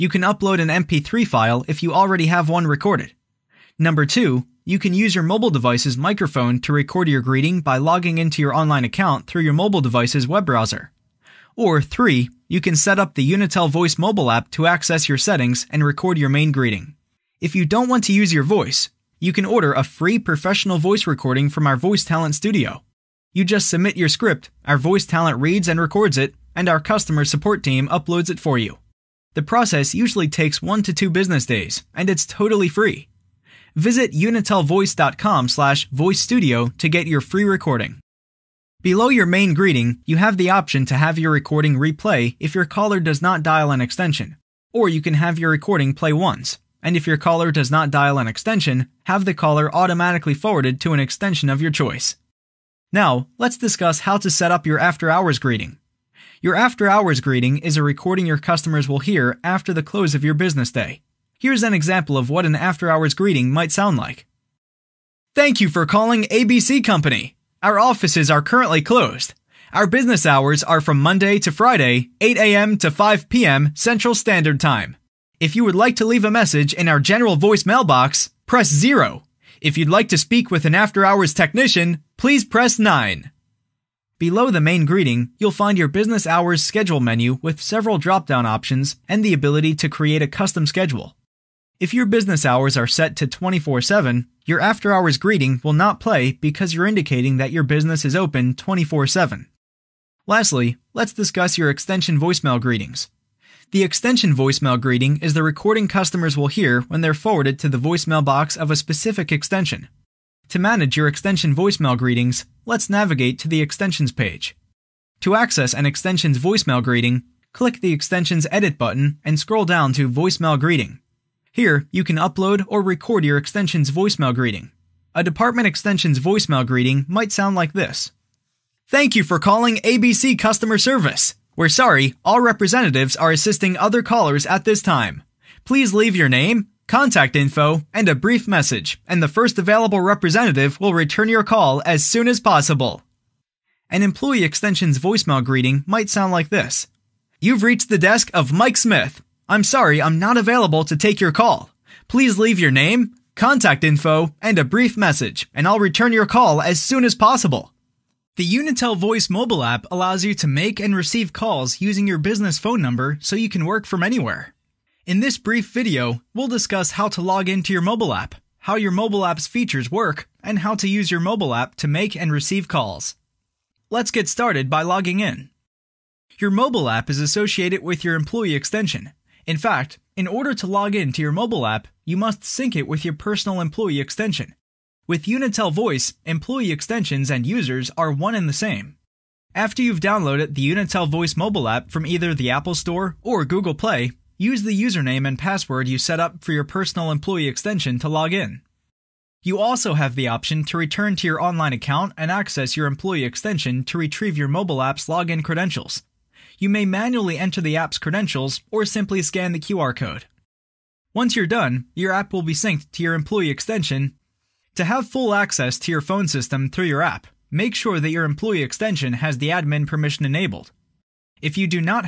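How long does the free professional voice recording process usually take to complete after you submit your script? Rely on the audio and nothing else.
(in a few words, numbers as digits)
1 to 2 business days.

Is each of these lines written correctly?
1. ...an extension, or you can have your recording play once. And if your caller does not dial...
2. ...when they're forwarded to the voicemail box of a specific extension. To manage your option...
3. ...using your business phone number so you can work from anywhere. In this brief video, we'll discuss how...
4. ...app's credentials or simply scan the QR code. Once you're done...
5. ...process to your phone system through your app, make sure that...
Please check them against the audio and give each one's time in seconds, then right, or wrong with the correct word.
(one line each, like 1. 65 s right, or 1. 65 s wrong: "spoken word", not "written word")
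1. 43 s right
2. 106 s wrong: "extension", not "option"
3. 161 s right
4. 207 s right
5. 215 s wrong: "access", not "process".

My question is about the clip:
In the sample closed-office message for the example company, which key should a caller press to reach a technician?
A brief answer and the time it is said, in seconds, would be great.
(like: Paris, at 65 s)
9, at 82 s.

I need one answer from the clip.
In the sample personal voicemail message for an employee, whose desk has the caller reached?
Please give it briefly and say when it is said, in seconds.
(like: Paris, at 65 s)
Mike Smith, at 148 s.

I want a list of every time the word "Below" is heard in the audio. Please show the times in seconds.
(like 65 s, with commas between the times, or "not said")
38 s, 84 s.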